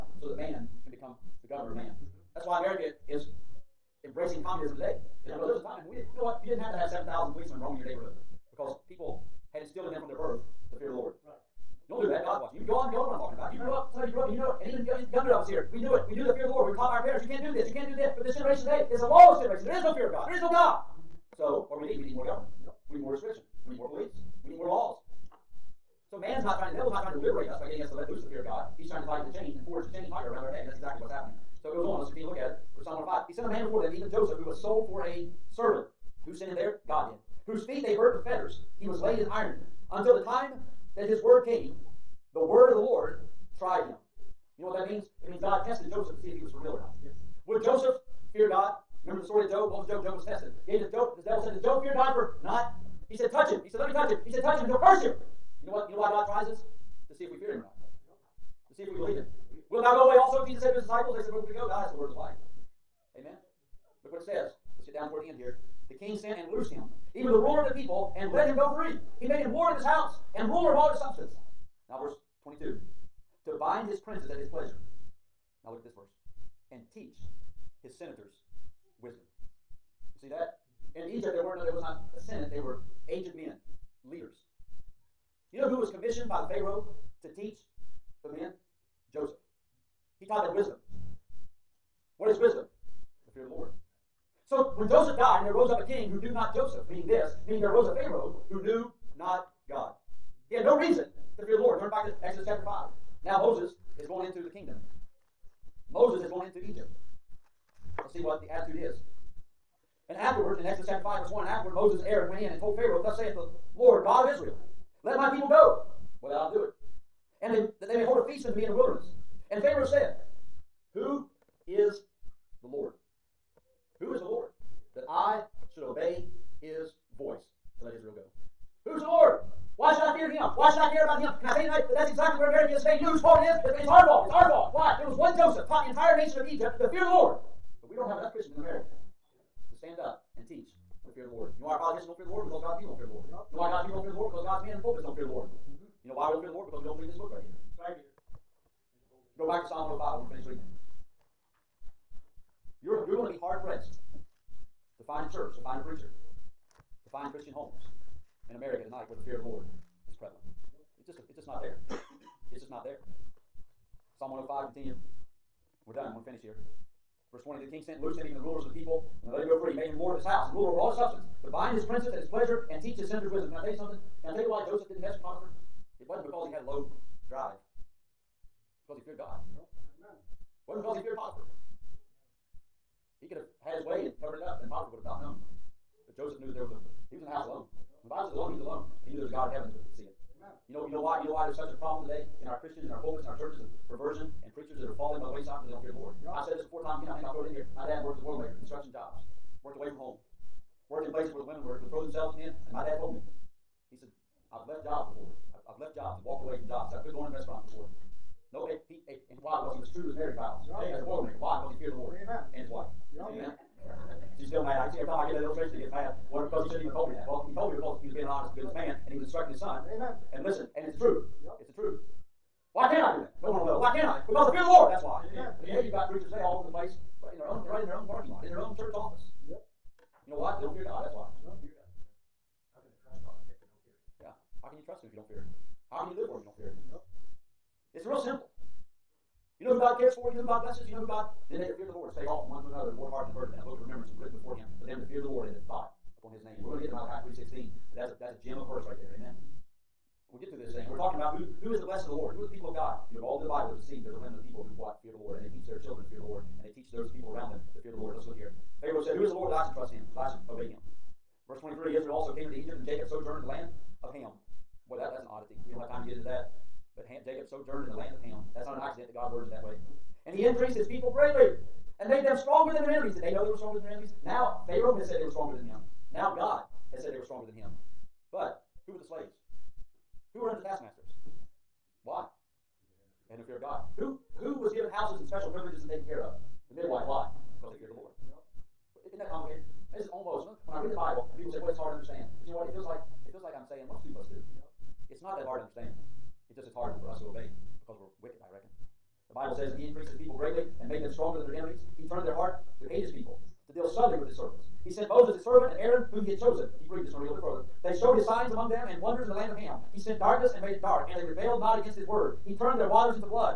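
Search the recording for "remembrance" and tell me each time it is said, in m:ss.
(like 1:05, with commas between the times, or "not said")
4:03.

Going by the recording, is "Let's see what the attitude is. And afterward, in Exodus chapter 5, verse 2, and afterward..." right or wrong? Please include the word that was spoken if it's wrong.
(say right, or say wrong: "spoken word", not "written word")
wrong: "1", not "2".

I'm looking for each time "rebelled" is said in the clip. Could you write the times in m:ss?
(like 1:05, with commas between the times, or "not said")
5:11.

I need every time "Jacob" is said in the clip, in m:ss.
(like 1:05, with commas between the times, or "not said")
4:22, 4:27.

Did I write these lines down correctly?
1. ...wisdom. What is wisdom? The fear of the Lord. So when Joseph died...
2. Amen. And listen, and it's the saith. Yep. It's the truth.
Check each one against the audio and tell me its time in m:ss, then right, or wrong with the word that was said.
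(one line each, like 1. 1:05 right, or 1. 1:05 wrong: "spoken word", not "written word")
1. 1:30 right
2. 3:39 wrong: "truth", not "saith".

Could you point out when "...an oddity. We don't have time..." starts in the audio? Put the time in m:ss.
4:25.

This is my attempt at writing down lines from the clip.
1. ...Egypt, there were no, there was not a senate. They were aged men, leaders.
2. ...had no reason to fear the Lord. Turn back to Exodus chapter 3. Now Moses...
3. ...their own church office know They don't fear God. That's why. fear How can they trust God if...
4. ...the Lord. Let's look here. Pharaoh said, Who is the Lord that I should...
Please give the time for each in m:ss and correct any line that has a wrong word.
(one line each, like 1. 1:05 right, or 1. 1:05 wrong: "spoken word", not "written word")
1. 1:21 right
2. 1:40 wrong: "5", not "3"
3. 3:48 right
4. 4:17 right.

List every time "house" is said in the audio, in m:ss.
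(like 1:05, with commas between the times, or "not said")
2:50, 3:07, 4:44.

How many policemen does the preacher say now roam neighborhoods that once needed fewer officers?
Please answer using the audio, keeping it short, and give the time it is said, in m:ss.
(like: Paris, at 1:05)
7,000, at 0:06.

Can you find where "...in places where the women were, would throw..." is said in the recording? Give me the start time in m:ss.
3:21.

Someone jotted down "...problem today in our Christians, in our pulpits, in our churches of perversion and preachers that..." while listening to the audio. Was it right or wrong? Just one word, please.
right.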